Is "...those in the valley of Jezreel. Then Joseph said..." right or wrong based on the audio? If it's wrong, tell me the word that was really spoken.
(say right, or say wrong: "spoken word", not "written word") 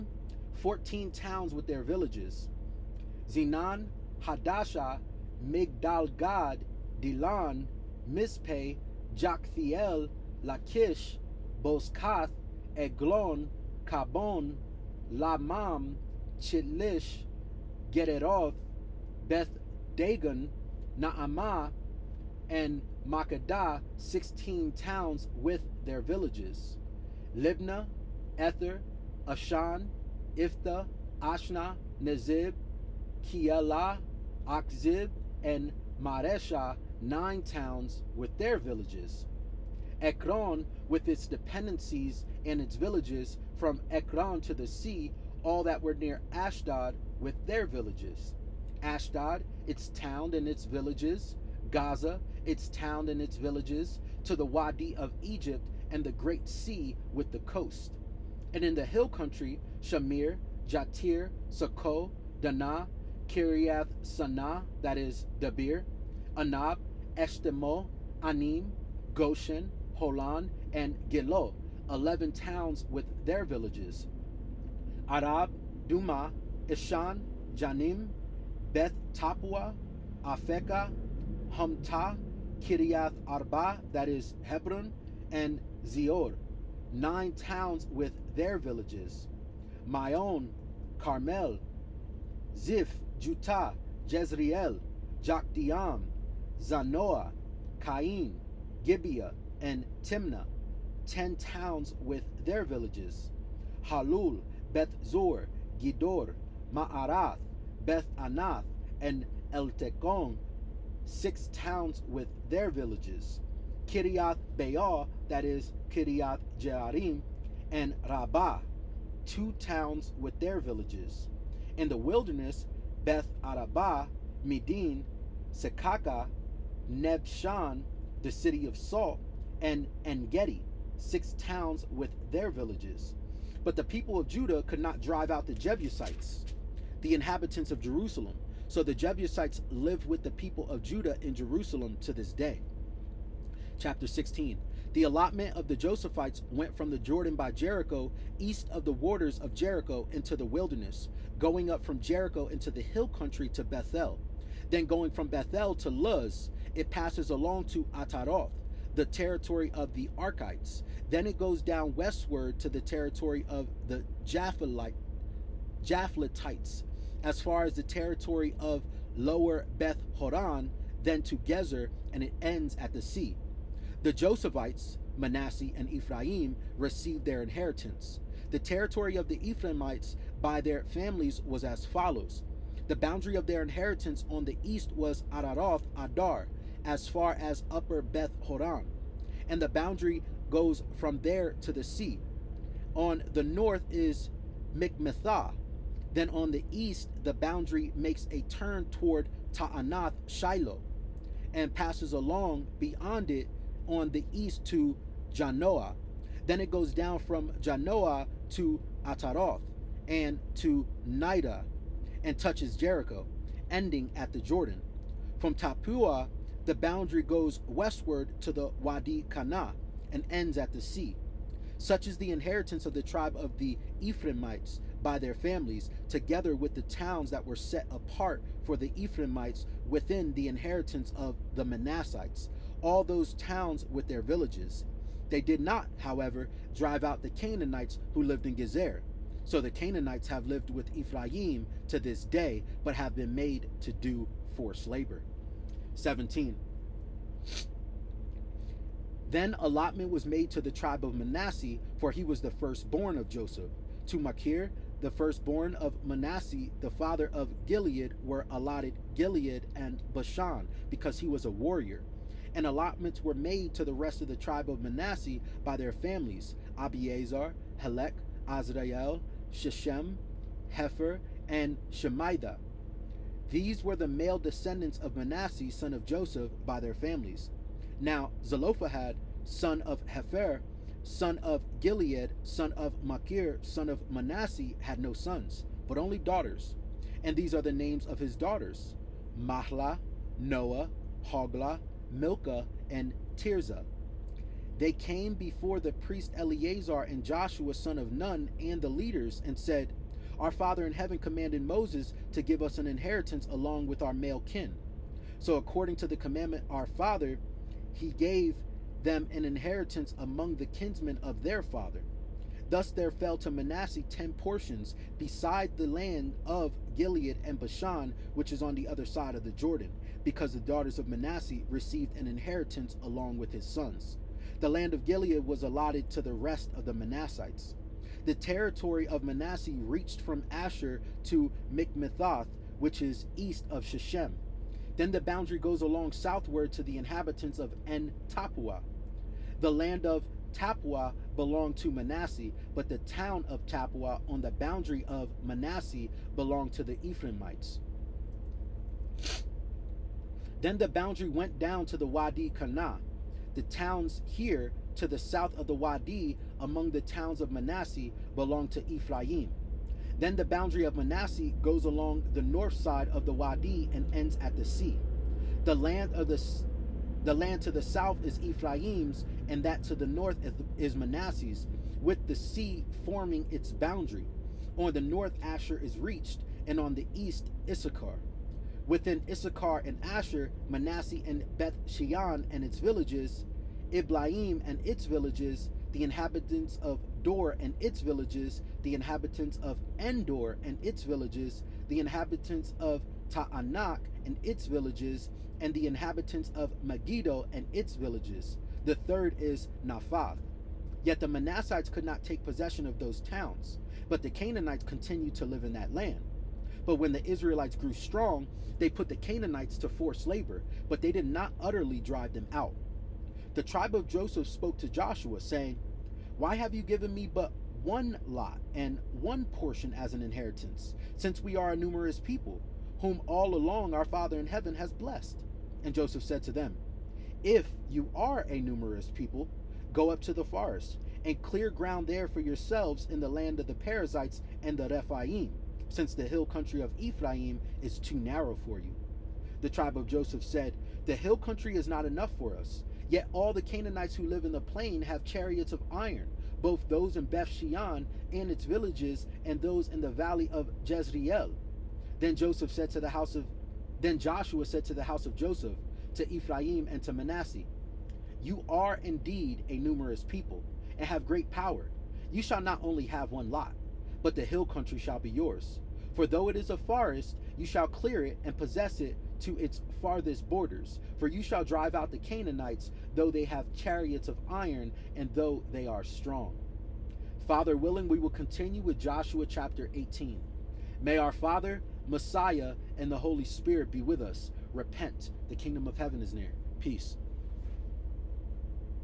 right.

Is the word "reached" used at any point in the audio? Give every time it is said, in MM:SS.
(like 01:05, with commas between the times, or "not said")
05:29, 06:15.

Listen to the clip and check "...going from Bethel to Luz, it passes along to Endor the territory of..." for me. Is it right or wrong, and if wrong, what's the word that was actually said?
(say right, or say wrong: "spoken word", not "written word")
wrong: "Ataroth", not "Endor".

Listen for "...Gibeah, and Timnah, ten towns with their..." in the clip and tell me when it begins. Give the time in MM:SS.
01:38.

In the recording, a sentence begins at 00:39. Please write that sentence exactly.
Ekron with its dependencies and its villages from Ekron to the sea all that were near Ashdod with their villages.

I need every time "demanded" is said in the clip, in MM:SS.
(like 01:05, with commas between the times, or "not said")
not said.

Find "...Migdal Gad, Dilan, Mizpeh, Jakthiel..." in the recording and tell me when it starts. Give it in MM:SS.
00:05.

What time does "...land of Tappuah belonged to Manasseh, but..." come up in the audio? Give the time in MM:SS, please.
05:39.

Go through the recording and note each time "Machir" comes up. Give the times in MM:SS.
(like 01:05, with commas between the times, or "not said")
04:14, 04:43.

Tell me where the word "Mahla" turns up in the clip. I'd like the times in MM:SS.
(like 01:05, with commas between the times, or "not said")
04:49.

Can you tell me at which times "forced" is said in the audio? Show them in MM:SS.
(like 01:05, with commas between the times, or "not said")
04:04, 06:49.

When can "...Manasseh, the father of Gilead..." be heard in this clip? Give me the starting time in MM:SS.
04:16.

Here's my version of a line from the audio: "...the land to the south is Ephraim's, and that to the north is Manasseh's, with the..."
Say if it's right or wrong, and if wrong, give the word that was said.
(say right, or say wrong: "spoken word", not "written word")
right.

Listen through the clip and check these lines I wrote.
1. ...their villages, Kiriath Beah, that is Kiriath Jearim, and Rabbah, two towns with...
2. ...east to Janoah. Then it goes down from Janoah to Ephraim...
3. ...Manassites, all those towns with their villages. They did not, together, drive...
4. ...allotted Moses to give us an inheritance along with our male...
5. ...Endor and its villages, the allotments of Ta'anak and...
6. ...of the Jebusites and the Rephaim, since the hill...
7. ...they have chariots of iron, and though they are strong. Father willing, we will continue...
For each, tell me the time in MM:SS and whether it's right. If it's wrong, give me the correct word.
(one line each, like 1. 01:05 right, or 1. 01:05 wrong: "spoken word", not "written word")
1. 01:52 right
2. 03:24 wrong: "Ataroth", not "Ephraim"
3. 03:51 wrong: "however", not "together"
4. 05:01 wrong: "commanded", not "allotted"
5. 06:29 wrong: "inhabitants", not "allotments"
6. 07:13 wrong: "Perizzites", not "Jebusites"
7. 07:53 right.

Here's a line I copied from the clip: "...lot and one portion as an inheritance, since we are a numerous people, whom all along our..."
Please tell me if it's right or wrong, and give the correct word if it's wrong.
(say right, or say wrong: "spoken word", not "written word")
right.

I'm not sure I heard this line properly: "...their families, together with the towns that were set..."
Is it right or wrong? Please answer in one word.
right.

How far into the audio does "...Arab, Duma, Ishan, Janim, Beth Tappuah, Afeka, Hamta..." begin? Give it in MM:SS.
01:15.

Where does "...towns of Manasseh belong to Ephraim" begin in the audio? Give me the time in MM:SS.
05:57.